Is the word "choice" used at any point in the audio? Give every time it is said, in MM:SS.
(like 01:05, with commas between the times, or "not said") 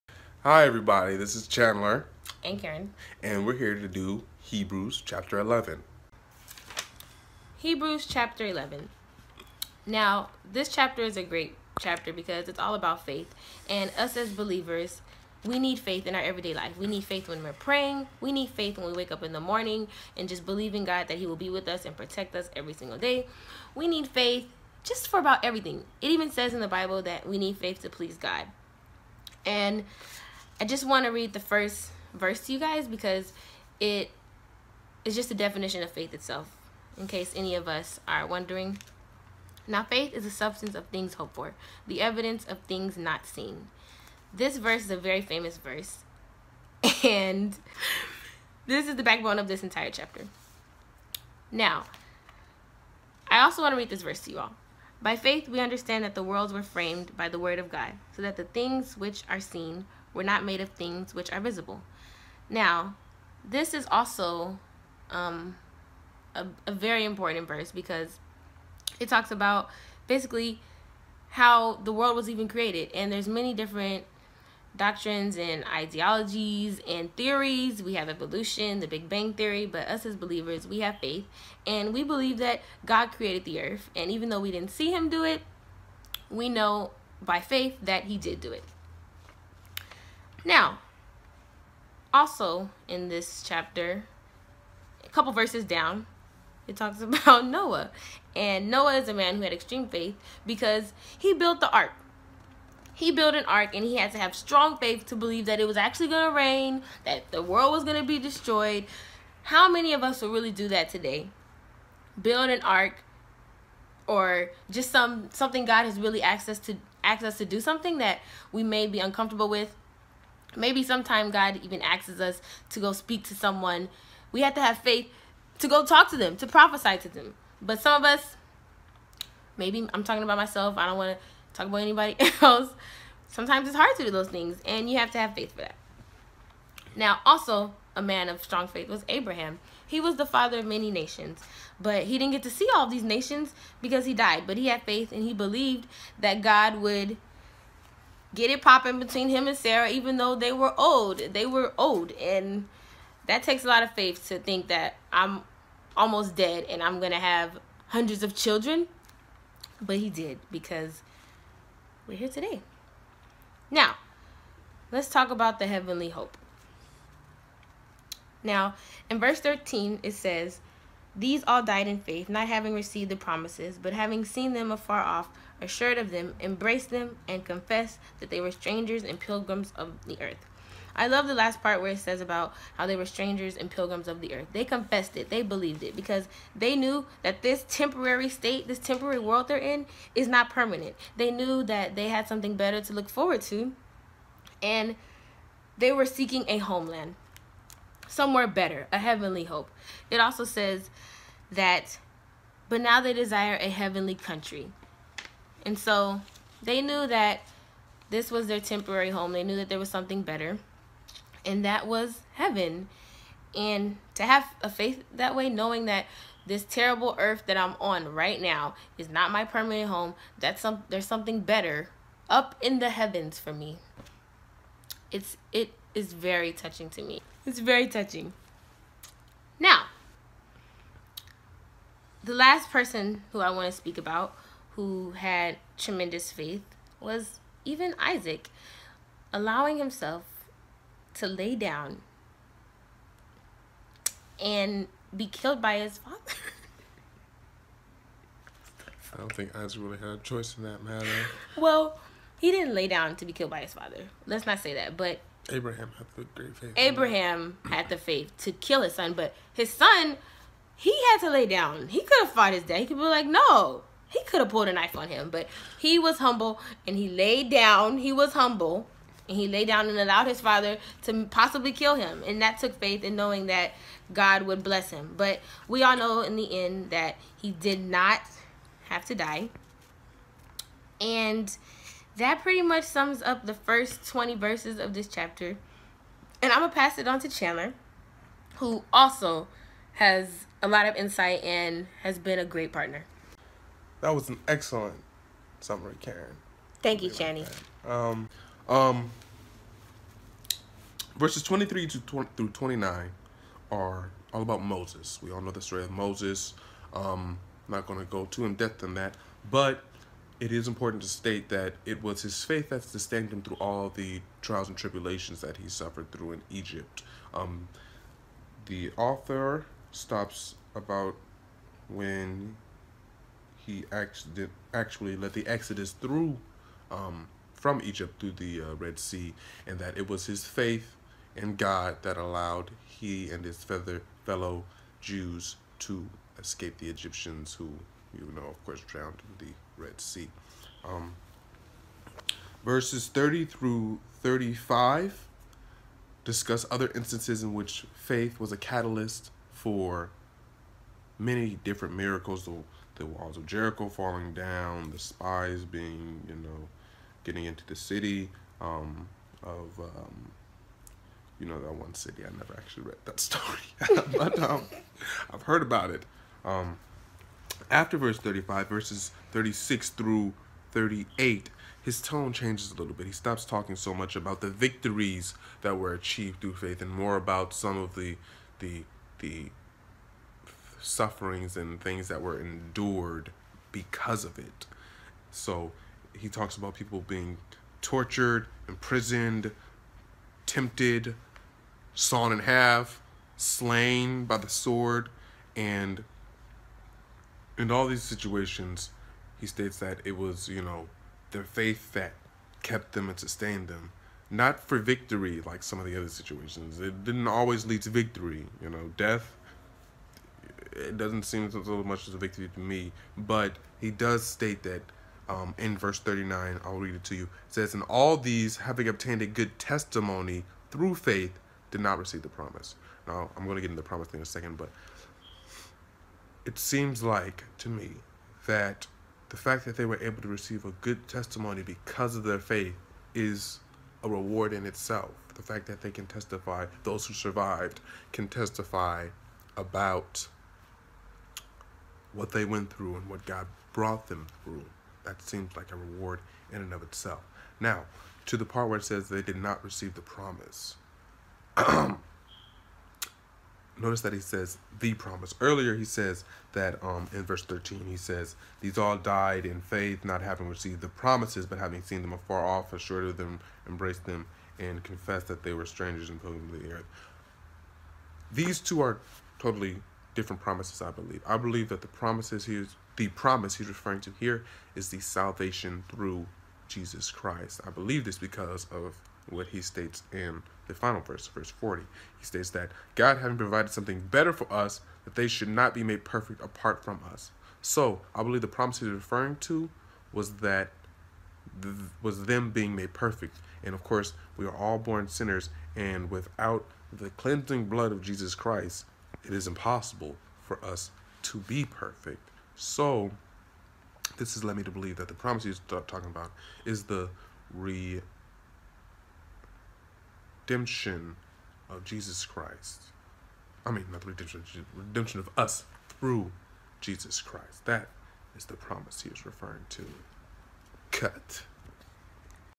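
04:10.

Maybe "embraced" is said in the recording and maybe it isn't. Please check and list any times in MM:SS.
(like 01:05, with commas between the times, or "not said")
02:56, 07:43.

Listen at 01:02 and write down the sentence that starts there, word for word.
Now, this is also um, a, a very important verse because it talks about basically how the world was even created.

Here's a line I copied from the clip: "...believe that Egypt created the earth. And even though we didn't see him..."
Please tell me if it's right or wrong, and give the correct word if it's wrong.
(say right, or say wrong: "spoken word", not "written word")
wrong: "God", not "Egypt".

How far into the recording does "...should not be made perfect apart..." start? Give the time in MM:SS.
08:05.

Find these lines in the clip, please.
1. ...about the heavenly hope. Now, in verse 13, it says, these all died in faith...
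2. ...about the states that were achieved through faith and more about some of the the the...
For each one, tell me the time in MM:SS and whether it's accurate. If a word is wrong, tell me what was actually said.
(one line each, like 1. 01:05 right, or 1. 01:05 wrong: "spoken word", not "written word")
1. 02:45 right
2. 06:14 wrong: "victories", not "states".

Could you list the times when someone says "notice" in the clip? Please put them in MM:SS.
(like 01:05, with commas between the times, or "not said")
07:33.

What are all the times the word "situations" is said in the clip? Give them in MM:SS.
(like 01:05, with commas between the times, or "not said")
06:38, 06:46.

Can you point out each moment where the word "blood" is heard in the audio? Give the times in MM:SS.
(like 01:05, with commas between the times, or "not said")
08:17.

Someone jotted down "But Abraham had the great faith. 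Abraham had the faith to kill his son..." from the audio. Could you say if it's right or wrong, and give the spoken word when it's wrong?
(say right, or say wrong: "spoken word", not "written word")
right.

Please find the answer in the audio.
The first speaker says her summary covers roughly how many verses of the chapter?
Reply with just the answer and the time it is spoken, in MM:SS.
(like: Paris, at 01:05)
20, at 04:44.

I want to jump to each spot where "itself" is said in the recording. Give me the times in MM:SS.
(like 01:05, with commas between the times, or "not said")
00:36, 07:14, 07:26.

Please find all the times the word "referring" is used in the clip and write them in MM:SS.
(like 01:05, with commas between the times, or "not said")
07:53, 08:08, 08:39.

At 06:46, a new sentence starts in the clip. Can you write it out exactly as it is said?
It didn't always lead to victory, you know, death.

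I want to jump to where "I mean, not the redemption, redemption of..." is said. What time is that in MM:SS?
08:33.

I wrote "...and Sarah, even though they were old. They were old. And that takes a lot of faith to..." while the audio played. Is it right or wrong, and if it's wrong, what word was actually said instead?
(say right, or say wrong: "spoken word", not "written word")
right.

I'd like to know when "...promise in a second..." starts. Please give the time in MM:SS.
07:03.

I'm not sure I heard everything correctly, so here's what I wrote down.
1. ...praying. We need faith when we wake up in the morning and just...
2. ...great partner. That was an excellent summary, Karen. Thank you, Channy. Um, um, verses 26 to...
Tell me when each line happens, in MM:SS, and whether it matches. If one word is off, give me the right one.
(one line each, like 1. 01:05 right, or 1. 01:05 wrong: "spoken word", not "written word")
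1. 00:17 right
2. 04:52 wrong: "23", not "26".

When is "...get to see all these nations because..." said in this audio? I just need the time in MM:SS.
02:22.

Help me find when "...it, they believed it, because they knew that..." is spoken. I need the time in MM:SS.
03:05.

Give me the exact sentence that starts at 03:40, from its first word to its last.
That's some there's something better up in the heavens for me.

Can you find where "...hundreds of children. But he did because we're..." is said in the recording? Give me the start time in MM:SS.
02:37.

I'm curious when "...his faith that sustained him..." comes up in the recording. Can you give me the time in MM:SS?
05:12.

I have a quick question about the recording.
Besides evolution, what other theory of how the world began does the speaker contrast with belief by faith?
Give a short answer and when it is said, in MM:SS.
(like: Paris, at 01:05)
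Big Bang Theory, at 01:18.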